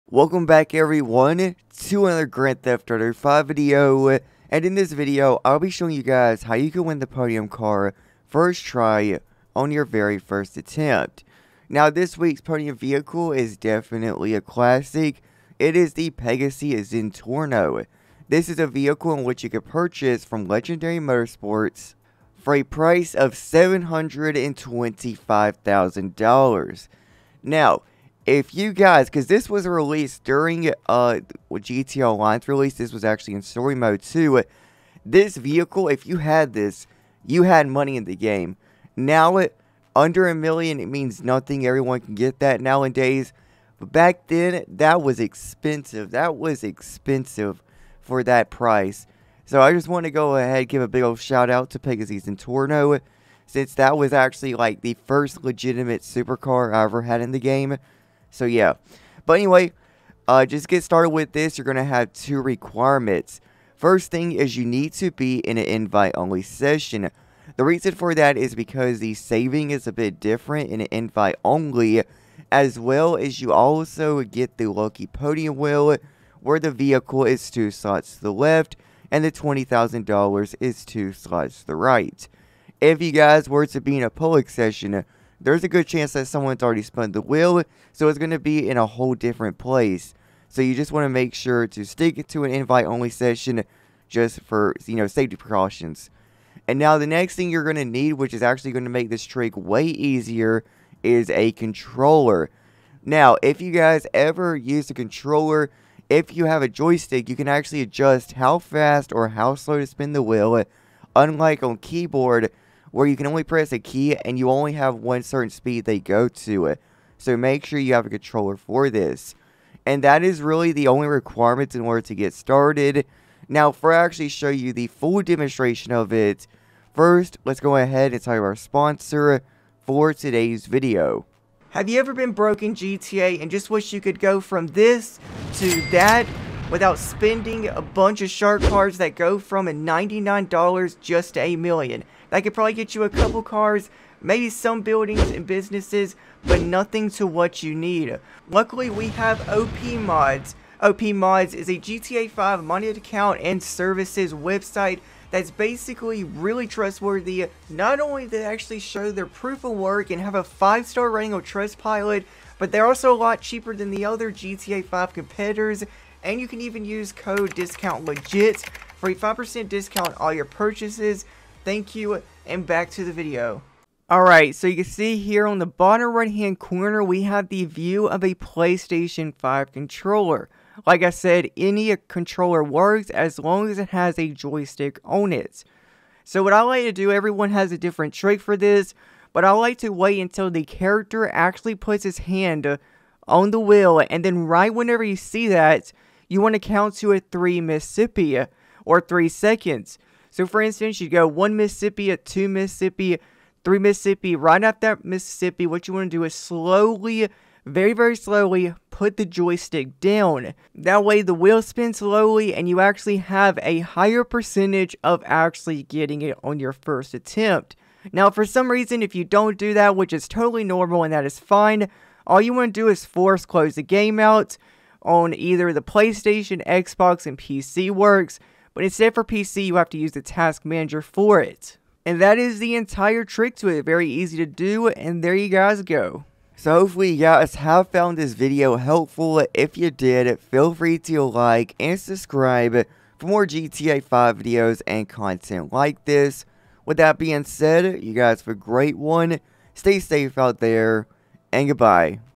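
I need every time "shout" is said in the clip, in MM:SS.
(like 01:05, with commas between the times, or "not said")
00:51.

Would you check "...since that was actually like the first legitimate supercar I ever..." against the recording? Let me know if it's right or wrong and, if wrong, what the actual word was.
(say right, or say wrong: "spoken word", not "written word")
right.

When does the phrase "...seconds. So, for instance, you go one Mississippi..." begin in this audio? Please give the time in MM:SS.
03:19.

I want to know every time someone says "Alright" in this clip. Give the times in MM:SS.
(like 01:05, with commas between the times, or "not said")
02:54.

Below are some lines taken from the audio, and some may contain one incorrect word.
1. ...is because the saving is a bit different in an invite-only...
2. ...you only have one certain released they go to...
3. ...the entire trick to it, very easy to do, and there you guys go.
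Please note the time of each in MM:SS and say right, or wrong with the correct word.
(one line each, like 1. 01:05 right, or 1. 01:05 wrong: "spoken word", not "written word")
1. 01:08 right
2. 01:54 wrong: "speed", not "released"
3. 03:52 right.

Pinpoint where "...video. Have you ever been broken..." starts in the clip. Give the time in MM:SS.
02:10.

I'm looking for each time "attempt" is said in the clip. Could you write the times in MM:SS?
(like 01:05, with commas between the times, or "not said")
00:10, 03:37.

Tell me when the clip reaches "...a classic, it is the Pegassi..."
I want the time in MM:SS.
00:14.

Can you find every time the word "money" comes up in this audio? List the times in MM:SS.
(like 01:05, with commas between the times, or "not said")
00:37, 02:32.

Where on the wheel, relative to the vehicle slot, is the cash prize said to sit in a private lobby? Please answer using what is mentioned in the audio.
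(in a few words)
Two slots to the right.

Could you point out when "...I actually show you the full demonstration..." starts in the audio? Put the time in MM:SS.
02:03.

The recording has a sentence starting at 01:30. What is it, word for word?
So you just want to make sure to stick to an invite-only session just for, you know, safety precautions.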